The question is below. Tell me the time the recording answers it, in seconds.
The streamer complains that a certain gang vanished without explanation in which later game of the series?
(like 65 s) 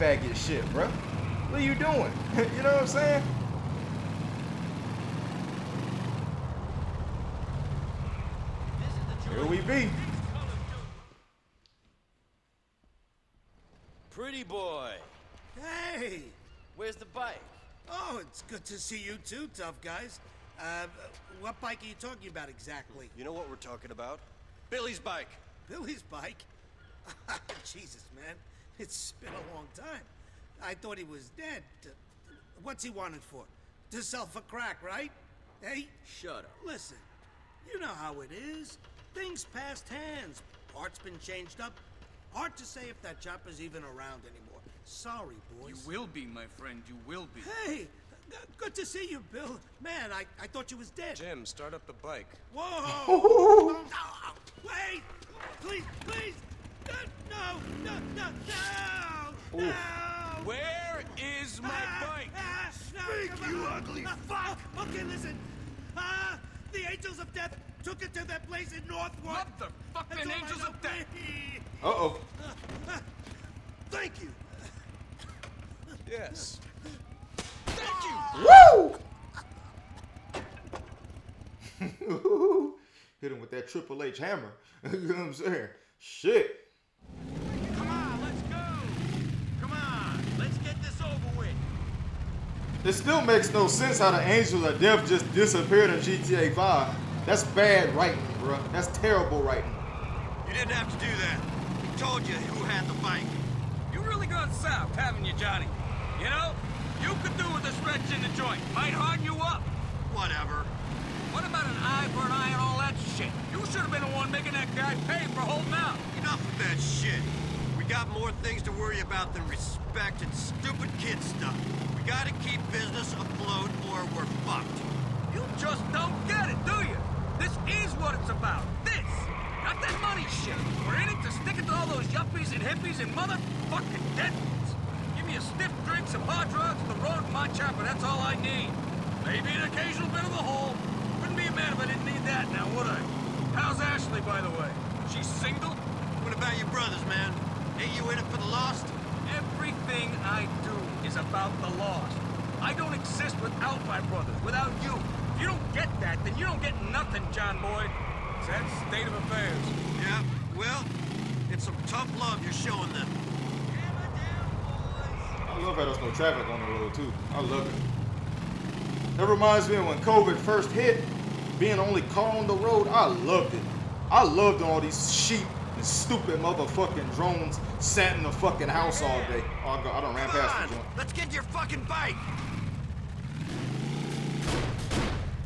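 96 s.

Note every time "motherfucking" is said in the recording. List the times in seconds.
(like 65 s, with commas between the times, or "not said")
133 s, 176 s.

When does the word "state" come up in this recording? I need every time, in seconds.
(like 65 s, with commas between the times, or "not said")
158 s.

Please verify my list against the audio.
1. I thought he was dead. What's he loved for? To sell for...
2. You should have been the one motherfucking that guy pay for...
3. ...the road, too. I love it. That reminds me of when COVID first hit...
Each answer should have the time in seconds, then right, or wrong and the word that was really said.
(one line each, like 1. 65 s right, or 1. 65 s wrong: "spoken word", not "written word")
1. 30 s wrong: "wanted", not "loved"
2. 113 s wrong: "making", not "motherfucking"
3. 166 s right.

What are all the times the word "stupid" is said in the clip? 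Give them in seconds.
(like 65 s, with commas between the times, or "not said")
120 s, 175 s.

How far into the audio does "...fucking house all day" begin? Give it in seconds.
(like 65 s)
178 s.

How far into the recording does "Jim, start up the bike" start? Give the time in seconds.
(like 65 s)
51 s.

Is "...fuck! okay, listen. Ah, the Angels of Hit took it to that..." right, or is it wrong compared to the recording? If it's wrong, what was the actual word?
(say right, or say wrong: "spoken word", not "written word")
wrong: "Death", not "Hit".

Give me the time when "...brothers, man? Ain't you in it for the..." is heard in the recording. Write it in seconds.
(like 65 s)
146 s.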